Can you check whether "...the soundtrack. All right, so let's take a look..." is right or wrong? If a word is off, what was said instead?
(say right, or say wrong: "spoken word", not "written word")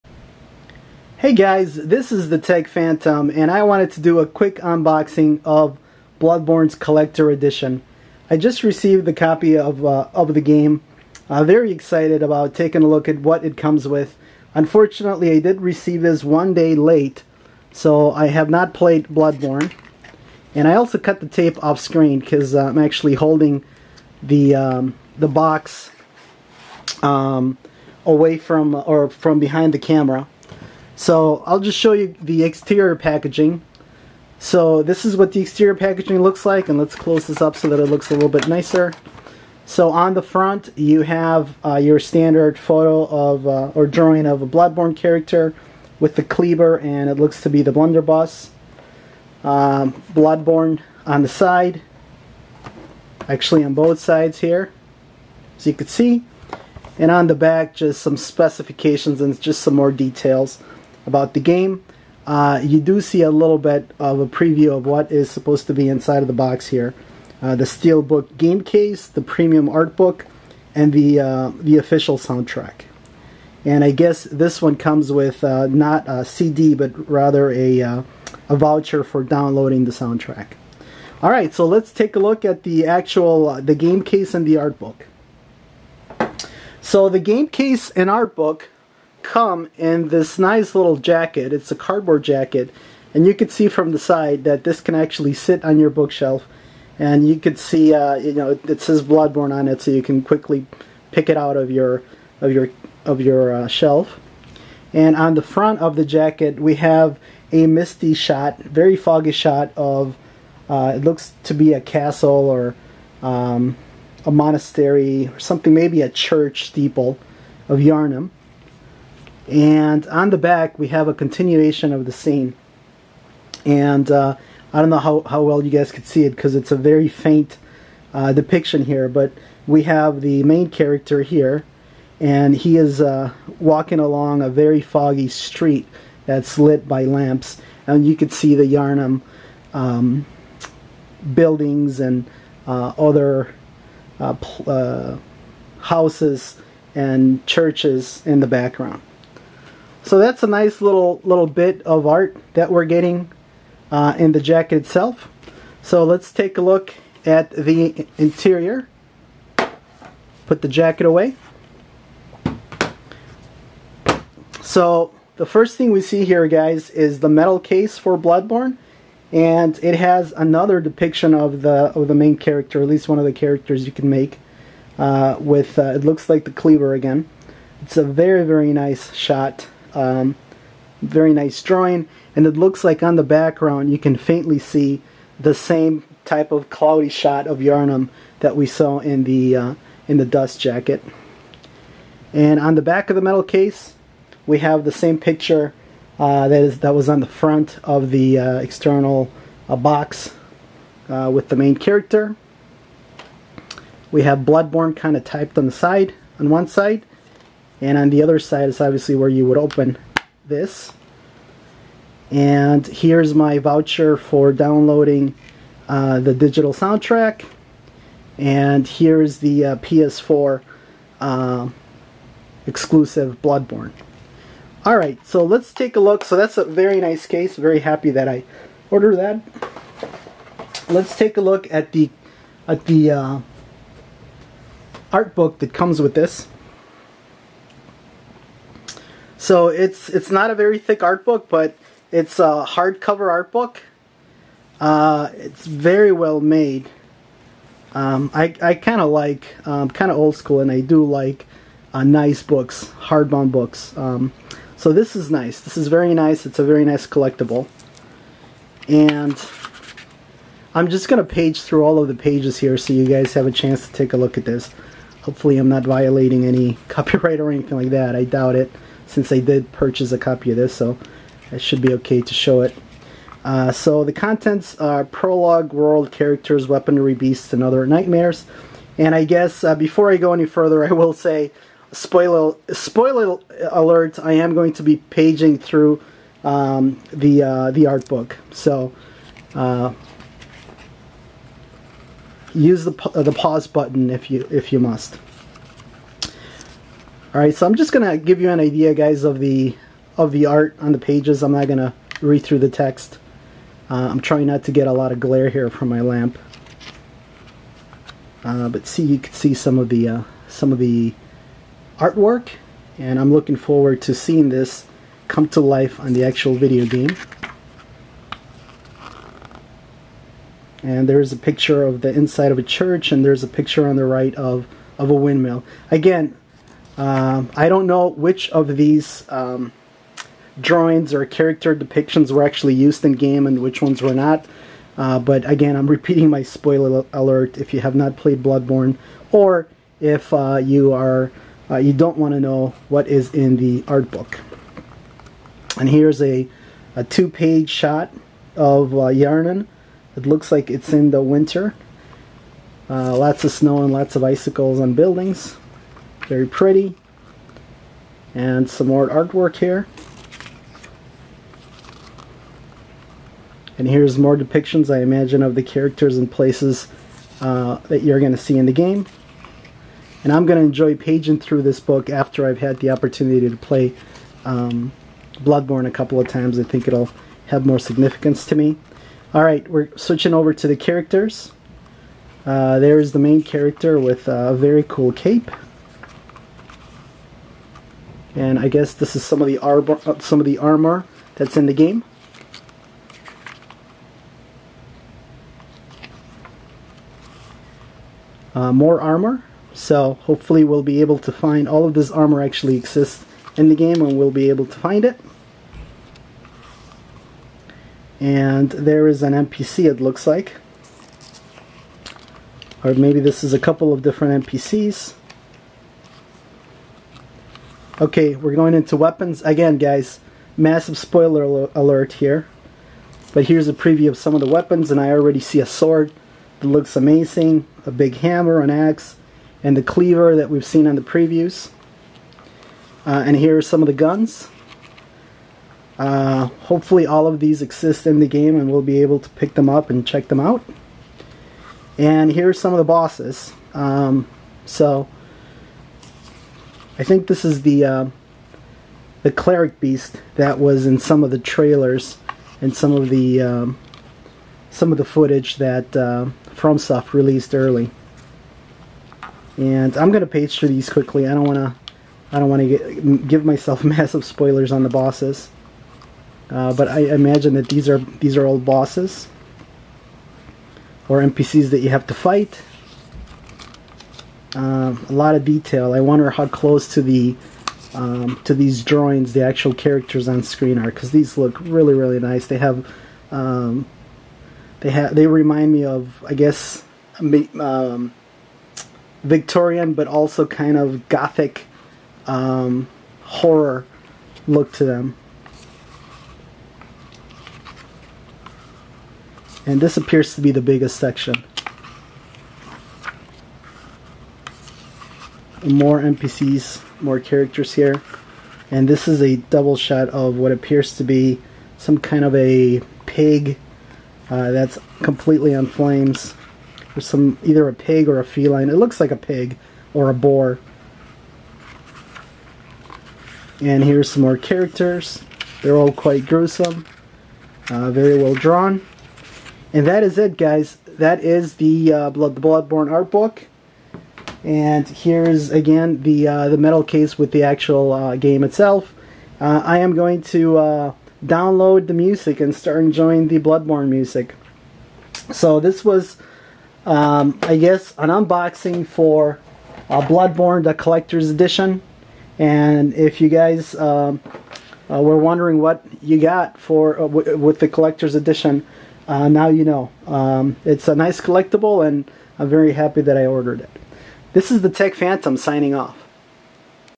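right.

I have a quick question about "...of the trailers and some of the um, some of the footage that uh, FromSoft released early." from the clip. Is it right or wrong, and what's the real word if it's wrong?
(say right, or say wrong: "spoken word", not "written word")
right.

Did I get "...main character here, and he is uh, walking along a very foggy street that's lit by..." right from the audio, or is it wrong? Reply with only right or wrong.
right.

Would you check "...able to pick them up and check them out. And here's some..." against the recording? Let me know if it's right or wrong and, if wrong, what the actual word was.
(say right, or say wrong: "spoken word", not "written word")
right.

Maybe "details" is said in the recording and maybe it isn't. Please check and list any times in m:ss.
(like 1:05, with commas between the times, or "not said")
0:59, 7:55.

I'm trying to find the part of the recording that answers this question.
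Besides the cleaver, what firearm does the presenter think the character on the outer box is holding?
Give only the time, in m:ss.
0:47.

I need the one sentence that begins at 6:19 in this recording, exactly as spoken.
All right, we're switching over to the characters.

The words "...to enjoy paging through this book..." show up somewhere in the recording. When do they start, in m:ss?
6:10.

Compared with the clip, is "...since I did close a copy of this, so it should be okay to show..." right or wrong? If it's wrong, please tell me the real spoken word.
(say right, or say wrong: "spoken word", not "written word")
wrong: "purchase", not "close".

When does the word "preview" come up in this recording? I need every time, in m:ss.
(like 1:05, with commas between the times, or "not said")
1:04, 7:03, 7:11.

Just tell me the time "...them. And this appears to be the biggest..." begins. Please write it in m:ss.
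8:14.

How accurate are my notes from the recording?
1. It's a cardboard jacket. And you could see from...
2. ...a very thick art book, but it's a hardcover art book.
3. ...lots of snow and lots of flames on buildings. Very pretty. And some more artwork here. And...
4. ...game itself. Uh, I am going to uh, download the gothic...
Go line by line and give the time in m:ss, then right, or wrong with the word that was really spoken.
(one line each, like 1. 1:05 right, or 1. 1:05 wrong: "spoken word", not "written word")
1. 1:31 right
2. 4:00 right
3. 5:53 wrong: "icicles", not "flames"
4. 8:58 wrong: "music", not "gothic".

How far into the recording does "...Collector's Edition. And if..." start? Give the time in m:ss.
9:10.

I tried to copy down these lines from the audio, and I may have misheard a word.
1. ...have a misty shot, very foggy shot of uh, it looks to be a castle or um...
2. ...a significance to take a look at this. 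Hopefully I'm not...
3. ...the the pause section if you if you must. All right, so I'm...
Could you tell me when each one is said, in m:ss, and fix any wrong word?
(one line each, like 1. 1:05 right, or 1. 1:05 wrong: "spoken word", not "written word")
1. 1:46 right
2. 4:23 wrong: "chance", not "significance"
3. 4:52 wrong: "button", not "section".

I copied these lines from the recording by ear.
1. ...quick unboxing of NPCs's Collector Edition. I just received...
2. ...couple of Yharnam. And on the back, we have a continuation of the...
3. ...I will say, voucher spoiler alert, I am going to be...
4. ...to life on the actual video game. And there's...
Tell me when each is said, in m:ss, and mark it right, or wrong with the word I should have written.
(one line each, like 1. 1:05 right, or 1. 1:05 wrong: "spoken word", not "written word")
1. 0:04 wrong: "Bloodborne", not "NPCs"
2. 1:56 wrong: "steeple", not "couple"
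3. 4:40 wrong: "spoiler", not "voucher"
4. 5:15 right.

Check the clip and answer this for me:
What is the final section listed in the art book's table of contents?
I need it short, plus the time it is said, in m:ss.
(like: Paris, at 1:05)
beasts, and other nightmares, at 4:37.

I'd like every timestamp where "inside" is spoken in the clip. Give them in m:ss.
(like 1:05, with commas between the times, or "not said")
1:05, 5:22.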